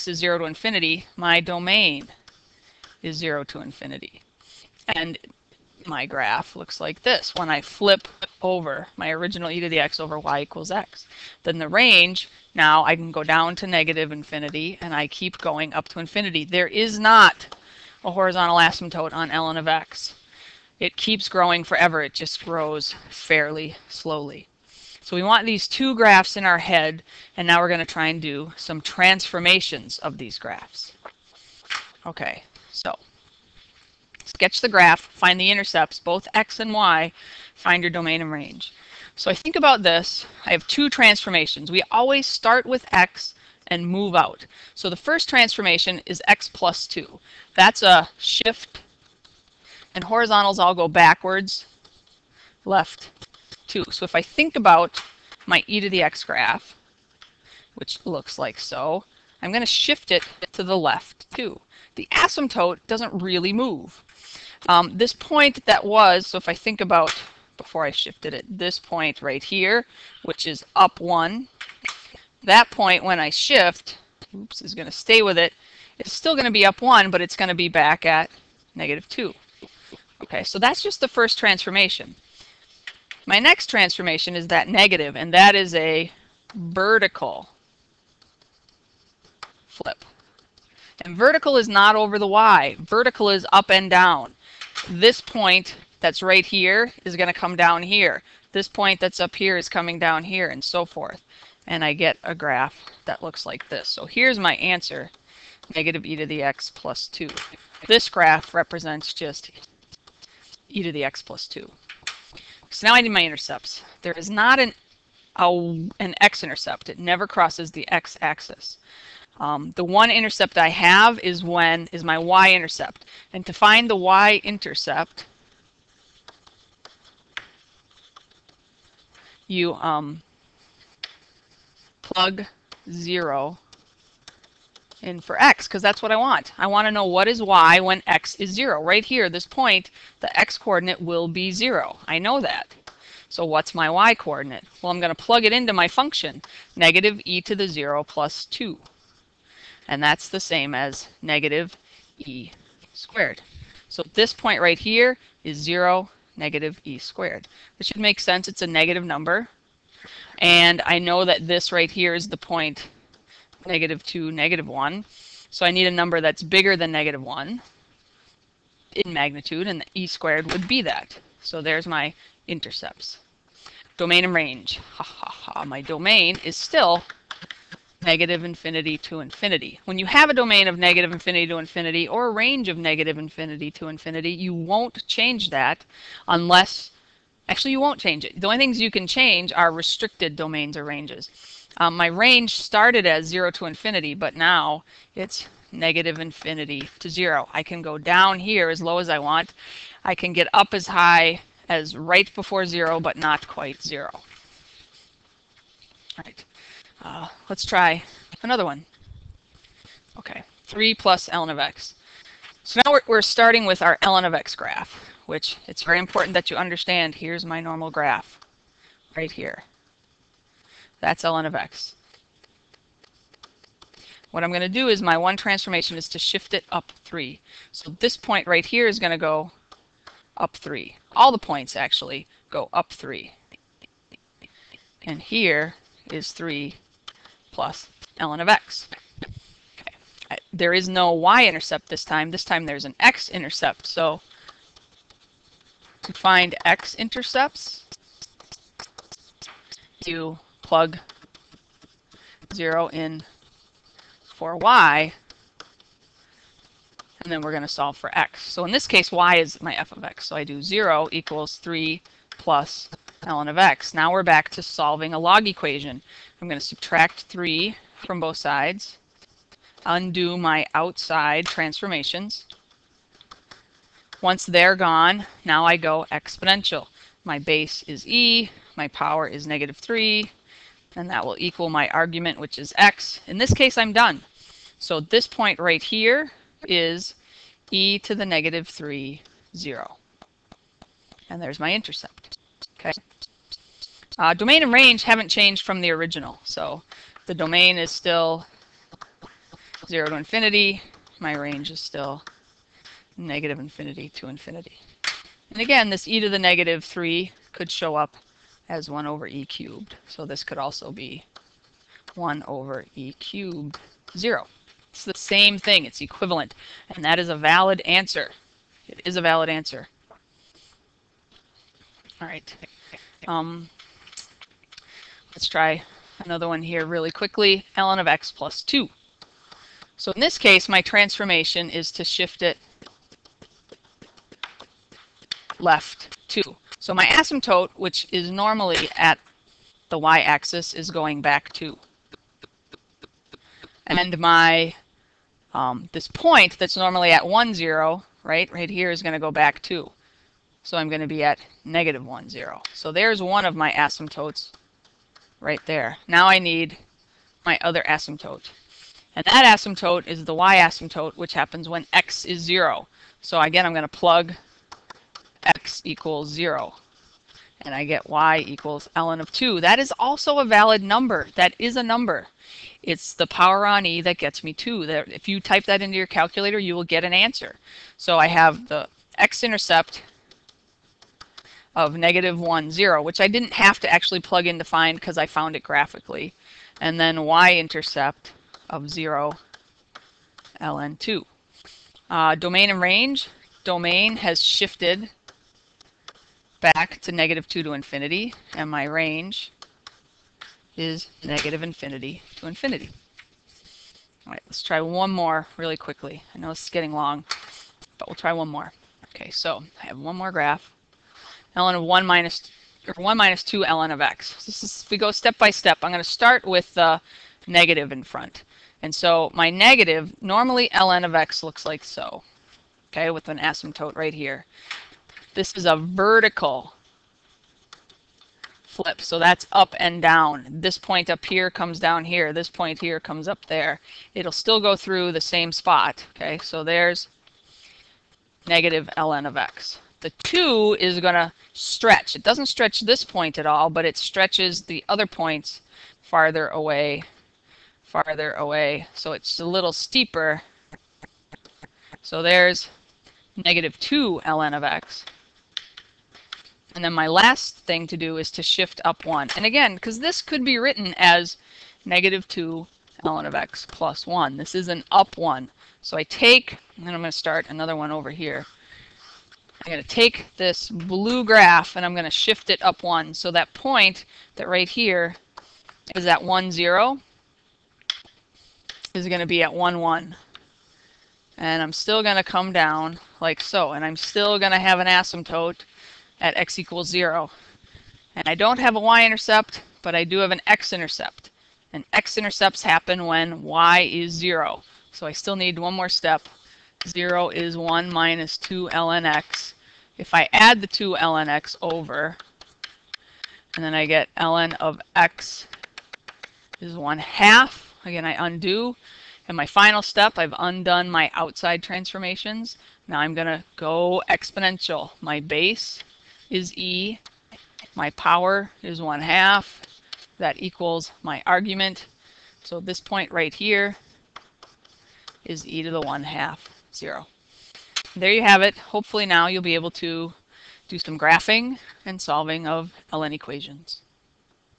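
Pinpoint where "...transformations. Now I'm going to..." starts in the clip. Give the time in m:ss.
8:31.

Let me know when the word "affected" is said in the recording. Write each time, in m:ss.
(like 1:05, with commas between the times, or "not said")
not said.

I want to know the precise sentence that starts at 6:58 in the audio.
And so my negative, normally ln of x looks like so, okay, with an asymptote right here.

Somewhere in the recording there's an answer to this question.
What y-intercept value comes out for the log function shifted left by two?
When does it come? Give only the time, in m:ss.
6:08.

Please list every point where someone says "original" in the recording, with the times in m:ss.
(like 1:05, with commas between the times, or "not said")
0:09, 4:55.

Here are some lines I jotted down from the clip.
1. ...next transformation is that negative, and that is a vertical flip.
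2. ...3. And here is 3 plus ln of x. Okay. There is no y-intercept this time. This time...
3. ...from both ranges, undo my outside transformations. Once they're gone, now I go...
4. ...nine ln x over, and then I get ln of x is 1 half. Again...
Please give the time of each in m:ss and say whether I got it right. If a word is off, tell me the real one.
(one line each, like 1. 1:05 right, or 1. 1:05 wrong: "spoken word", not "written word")
1. 1:23 right
2. 3:52 right
3. 4:28 wrong: "sides", not "ranges"
4. 8:20 wrong: "two", not "nine".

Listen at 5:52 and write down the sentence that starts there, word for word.
So there's one of my asymptotes right there.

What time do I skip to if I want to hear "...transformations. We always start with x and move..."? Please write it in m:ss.
0:40.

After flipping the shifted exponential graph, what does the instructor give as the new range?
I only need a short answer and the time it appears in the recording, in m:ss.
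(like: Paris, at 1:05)
negative infinity to 0, at 3:15.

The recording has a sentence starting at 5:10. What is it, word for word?
So this could also be 1 over e cubed 0.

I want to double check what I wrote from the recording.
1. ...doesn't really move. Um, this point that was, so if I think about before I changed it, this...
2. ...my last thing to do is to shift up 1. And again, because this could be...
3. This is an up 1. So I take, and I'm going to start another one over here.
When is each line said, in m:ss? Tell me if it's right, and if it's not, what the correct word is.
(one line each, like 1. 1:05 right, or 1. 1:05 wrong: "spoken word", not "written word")
1. 1:02 wrong: "shifted", not "changed"
2. 7:36 right
3. 7:44 right.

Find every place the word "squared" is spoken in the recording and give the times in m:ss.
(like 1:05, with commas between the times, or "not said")
2:32, 2:36, 2:50.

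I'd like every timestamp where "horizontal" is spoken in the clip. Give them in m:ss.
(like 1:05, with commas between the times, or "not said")
0:18, 0:50.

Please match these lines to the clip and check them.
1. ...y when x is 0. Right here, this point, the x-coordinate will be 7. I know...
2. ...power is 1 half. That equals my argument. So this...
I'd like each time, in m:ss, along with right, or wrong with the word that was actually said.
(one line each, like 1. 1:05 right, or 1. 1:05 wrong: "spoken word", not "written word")
1. 2:17 wrong: "0", not "7"
2. 8:37 right.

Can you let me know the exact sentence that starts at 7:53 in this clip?
So that point that right here is at 1, 0 is going to be at 1, 1.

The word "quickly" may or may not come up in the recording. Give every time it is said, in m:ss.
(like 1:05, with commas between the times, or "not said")
5:27, 6:45.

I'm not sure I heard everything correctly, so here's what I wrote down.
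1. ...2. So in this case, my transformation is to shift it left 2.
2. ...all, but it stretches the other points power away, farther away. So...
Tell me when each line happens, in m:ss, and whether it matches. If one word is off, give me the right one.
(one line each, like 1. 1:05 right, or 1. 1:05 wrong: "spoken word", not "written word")
1. 5:28 right
2. 7:23 wrong: "farther", not "power".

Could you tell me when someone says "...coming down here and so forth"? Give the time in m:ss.
1:39.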